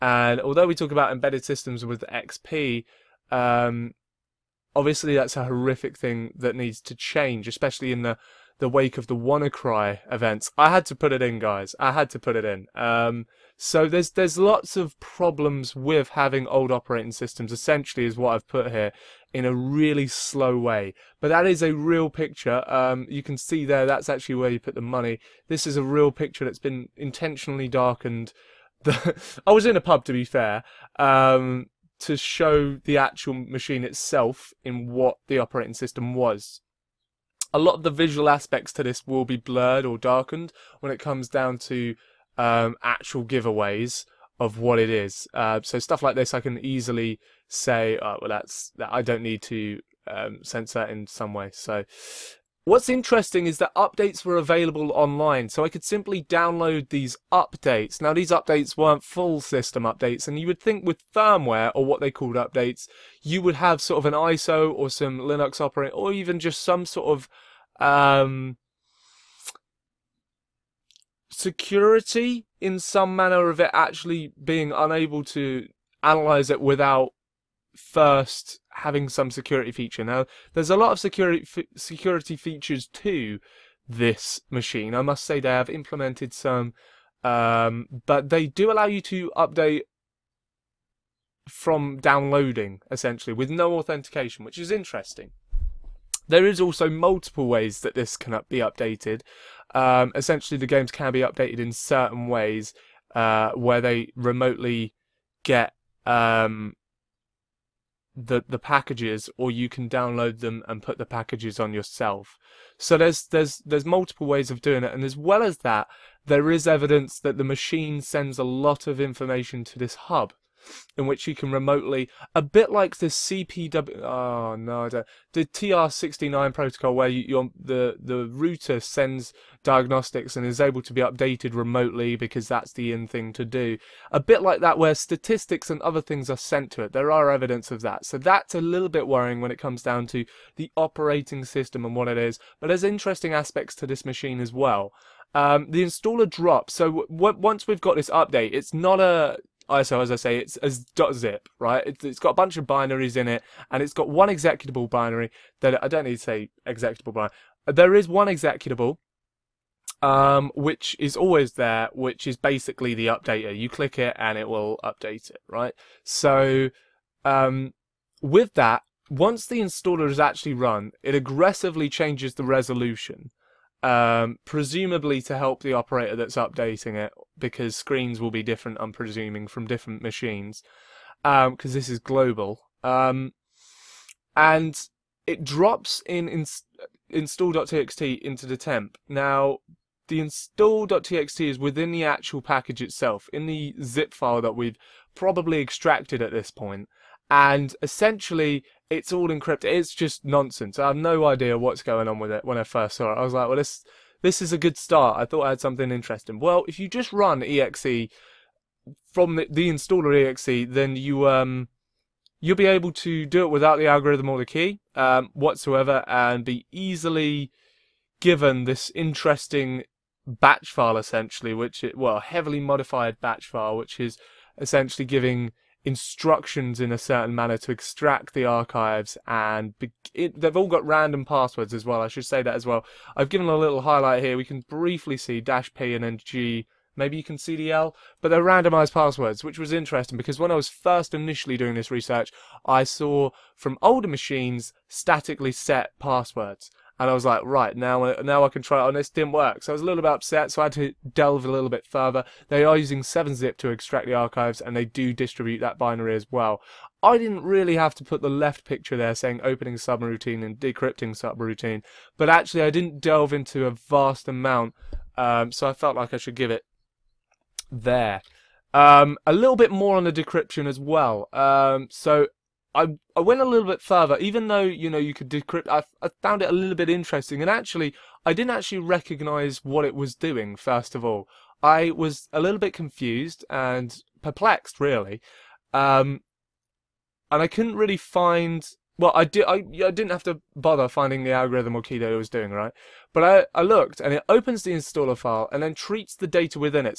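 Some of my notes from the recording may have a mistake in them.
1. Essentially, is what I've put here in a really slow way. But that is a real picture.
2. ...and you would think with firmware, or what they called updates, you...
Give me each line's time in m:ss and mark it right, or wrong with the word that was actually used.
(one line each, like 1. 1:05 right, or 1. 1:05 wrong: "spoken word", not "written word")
1. 0:17 right
2. 1:00 right.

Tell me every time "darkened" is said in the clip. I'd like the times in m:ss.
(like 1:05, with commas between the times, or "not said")
0:27, 0:39.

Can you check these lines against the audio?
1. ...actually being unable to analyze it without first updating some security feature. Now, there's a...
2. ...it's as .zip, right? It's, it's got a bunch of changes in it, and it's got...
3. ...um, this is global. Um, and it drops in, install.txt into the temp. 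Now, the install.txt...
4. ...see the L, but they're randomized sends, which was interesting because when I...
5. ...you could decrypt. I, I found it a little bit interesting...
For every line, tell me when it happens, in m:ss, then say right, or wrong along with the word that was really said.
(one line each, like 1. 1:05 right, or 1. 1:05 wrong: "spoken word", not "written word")
1. 1:13 wrong: "having", not "updating"
2. 2:30 wrong: "binaries", not "changes"
3. 3:01 right
4. 3:57 wrong: "passwords", not "sends"
5. 4:34 right.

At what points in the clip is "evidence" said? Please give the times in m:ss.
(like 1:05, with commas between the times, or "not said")
1:56, 2:17.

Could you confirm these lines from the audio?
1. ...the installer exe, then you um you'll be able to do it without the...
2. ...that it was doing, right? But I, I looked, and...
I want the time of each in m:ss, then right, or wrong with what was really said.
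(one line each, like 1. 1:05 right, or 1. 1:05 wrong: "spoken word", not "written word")
1. 3:29 right
2. 4:51 right.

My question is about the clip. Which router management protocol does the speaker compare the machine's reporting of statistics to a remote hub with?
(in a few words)
TR69.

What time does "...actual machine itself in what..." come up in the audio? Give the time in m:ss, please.
0:32.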